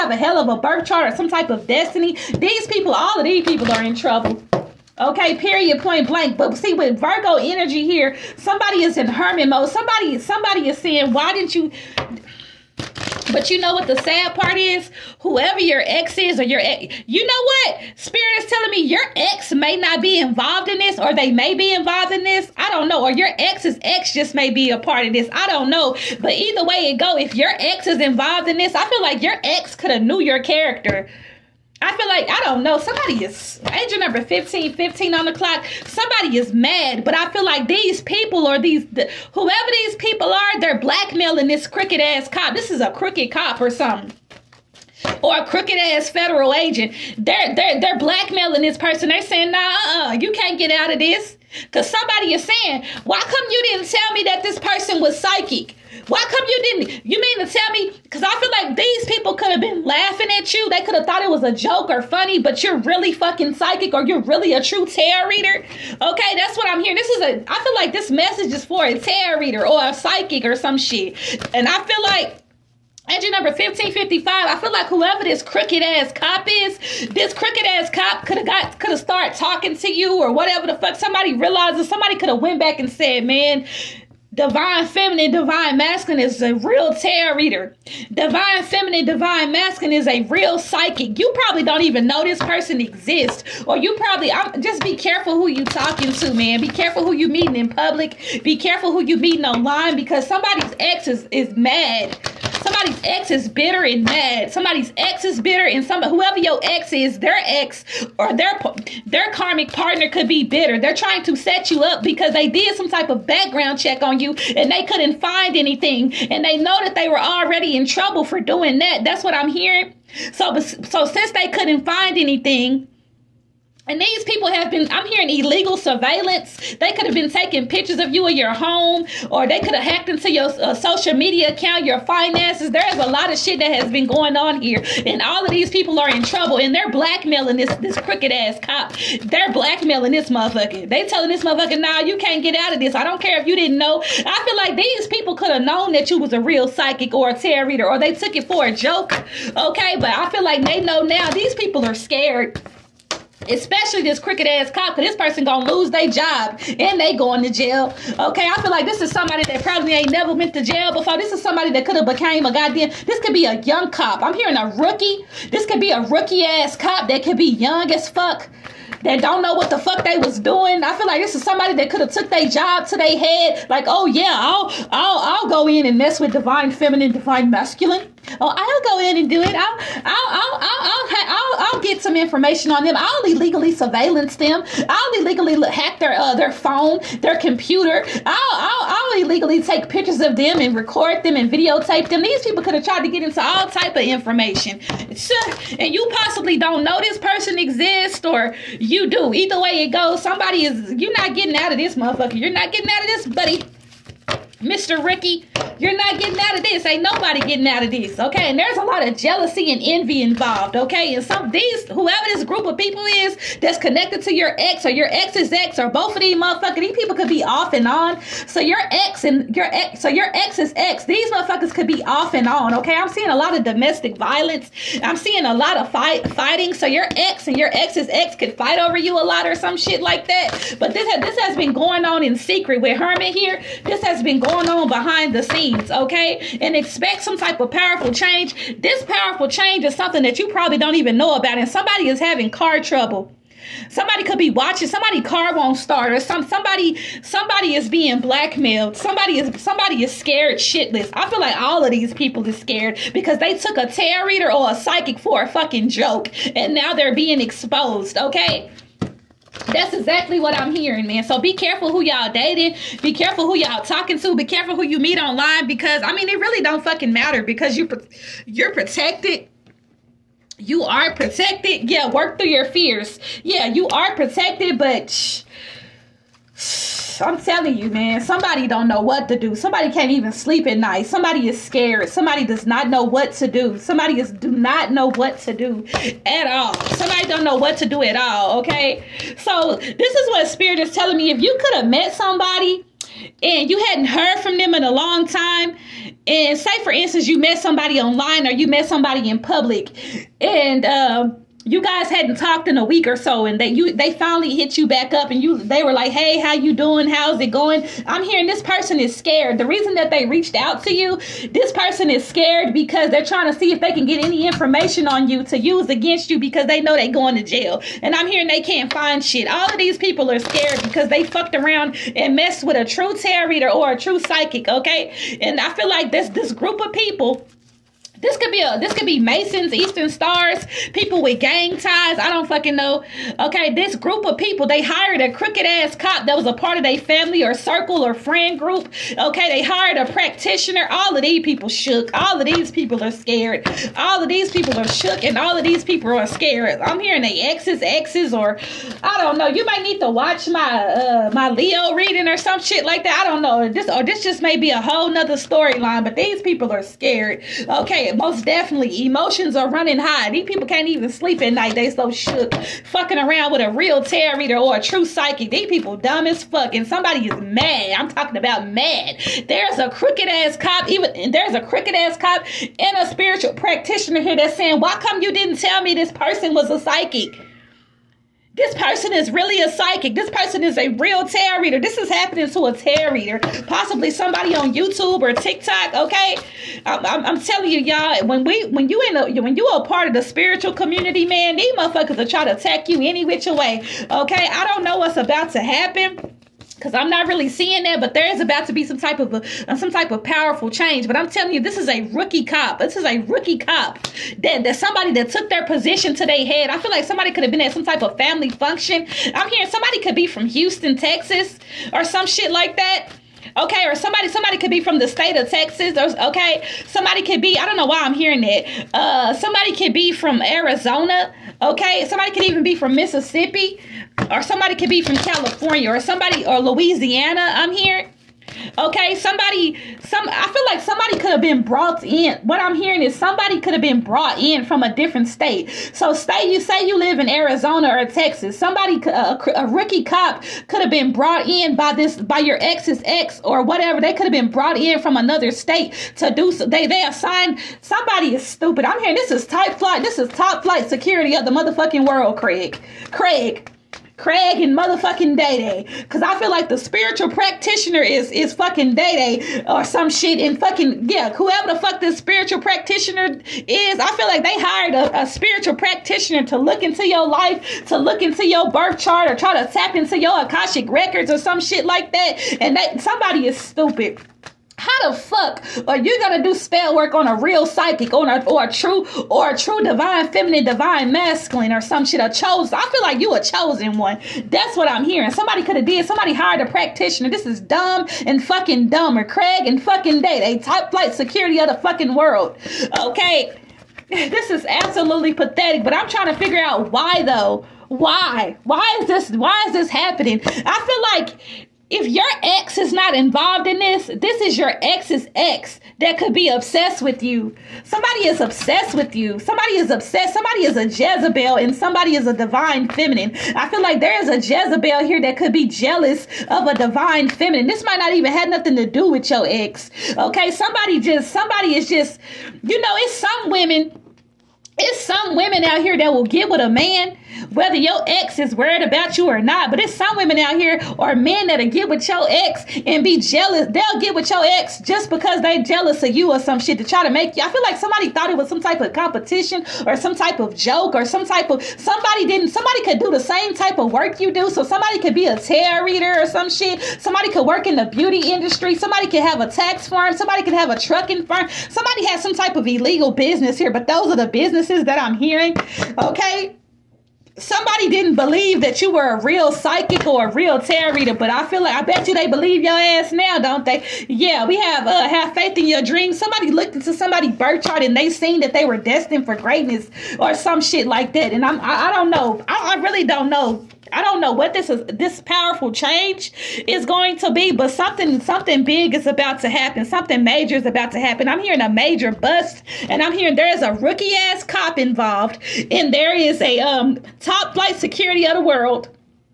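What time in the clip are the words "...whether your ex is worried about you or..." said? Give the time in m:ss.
8:47.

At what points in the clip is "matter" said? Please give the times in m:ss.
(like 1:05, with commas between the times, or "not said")
4:27.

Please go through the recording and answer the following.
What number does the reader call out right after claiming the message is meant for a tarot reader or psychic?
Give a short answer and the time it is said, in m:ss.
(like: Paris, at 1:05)
1555, at 1:13.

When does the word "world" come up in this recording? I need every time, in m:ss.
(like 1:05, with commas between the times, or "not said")
7:32, 8:12, 9:48.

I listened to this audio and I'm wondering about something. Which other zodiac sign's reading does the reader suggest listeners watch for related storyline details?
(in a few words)
Leo reading.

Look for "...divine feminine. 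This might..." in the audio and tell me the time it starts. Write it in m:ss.
8:36.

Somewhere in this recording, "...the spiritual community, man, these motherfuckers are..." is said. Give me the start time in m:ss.
6:30.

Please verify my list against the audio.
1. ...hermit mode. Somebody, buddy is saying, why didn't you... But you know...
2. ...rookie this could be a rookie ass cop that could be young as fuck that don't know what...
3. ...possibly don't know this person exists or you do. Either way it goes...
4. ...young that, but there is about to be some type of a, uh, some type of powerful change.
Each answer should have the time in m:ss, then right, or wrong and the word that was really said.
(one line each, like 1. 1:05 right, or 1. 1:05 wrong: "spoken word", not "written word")
1. 0:09 wrong: "somebody", not "buddy"
2. 2:44 right
3. 3:16 right
4. 6:37 wrong: "seeing", not "young".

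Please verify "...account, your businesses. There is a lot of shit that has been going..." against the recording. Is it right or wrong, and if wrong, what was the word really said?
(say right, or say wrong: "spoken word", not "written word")
wrong: "finances", not "businesses".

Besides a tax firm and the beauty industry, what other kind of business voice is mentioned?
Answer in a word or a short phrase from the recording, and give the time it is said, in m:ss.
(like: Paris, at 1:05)
Trucking firm, at 9:10.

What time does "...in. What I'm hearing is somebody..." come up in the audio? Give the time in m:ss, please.
7:12.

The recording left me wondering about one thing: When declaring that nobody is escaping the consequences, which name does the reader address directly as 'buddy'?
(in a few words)
Mr. Ricky.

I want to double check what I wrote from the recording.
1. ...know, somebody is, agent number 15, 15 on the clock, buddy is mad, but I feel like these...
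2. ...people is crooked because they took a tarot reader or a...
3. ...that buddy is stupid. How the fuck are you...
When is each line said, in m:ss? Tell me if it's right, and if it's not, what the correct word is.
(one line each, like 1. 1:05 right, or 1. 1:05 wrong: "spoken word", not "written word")
1. 0:32 wrong: "somebody", not "buddy"
2. 4:12 wrong: "scared", not "crooked"
3. 7:52 wrong: "somebody", not "buddy".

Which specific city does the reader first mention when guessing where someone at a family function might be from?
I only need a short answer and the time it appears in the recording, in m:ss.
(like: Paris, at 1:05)
Houston, at 6:50.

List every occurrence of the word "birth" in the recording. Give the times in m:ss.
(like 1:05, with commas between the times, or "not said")
0:00, 7:48, 9:27.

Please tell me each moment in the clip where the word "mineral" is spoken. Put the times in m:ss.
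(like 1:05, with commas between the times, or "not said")
not said.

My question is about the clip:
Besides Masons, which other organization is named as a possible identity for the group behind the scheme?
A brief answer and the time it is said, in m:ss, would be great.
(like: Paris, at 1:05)
Eastern Stars, at 5:29.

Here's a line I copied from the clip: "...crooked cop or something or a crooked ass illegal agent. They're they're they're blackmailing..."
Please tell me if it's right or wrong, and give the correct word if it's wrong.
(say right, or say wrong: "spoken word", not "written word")
wrong: "federal", not "illegal".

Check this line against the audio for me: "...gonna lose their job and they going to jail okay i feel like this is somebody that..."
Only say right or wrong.
right.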